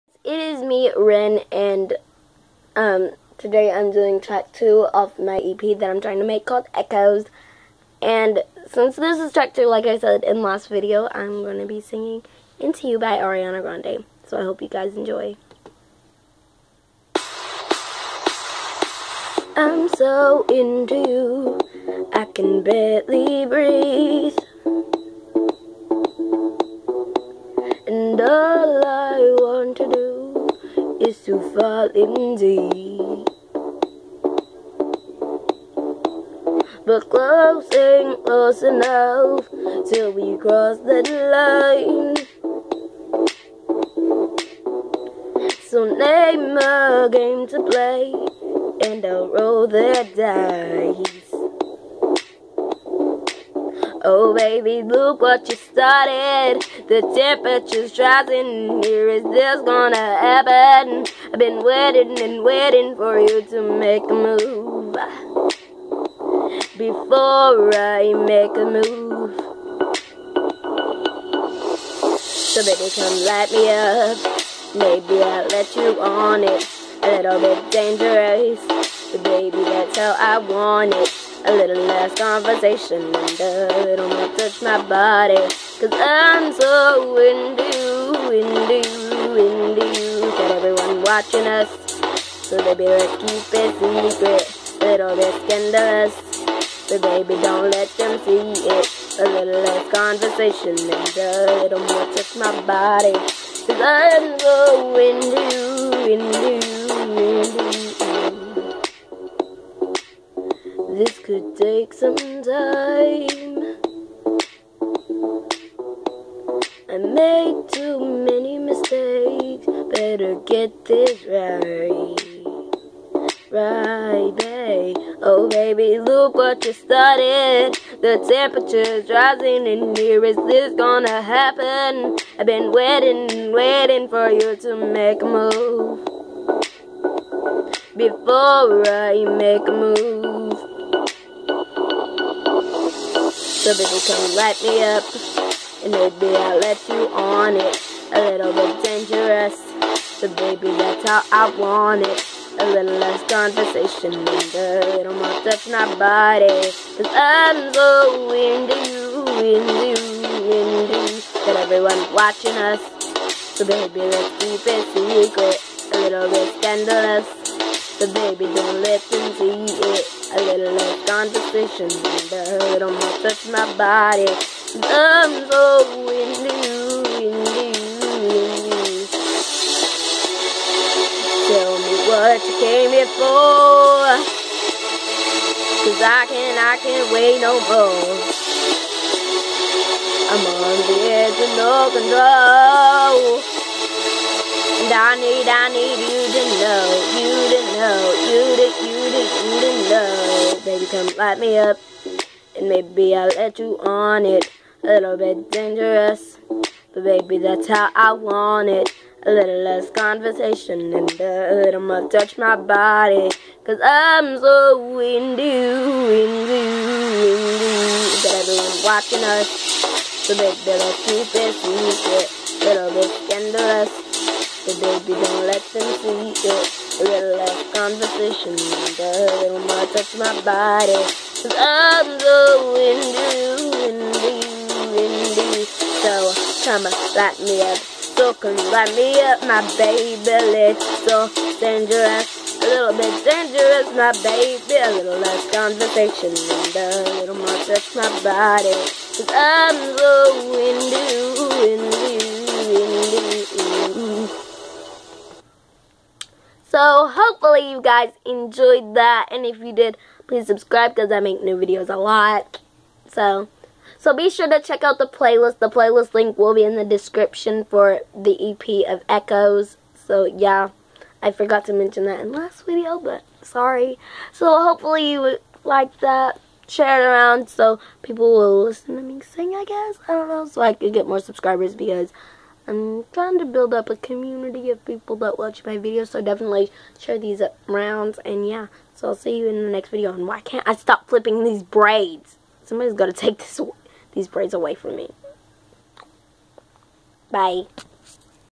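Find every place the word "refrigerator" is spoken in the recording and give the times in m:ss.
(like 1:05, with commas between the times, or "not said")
not said.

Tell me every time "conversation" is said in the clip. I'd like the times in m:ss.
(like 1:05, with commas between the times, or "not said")
1:22, 1:39, 2:33, 2:51, 3:29, 3:47, 4:05.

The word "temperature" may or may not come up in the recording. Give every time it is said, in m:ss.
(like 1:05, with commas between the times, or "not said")
0:57, 2:08.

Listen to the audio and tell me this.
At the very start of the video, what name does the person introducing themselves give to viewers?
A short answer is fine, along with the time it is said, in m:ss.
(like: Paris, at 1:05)
Rin, at 0:00.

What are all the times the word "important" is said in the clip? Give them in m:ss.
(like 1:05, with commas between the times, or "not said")
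not said.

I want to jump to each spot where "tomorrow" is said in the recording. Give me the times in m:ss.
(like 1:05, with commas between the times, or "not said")
not said.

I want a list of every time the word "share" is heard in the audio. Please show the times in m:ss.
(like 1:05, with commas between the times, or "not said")
4:36, 4:46.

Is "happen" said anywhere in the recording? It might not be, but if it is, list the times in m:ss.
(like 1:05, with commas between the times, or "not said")
1:00, 2:11.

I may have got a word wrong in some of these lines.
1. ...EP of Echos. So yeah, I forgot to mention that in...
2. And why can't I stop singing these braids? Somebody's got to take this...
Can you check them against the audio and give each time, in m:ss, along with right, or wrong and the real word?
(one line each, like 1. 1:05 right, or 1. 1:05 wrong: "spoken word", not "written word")
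1. 4:28 right
2. 4:50 wrong: "flipping", not "singing".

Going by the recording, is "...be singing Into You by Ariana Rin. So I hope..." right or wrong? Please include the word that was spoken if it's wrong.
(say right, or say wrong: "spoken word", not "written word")
wrong: "Grande", not "Rin".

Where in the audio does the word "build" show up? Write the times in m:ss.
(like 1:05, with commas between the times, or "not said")
4:43.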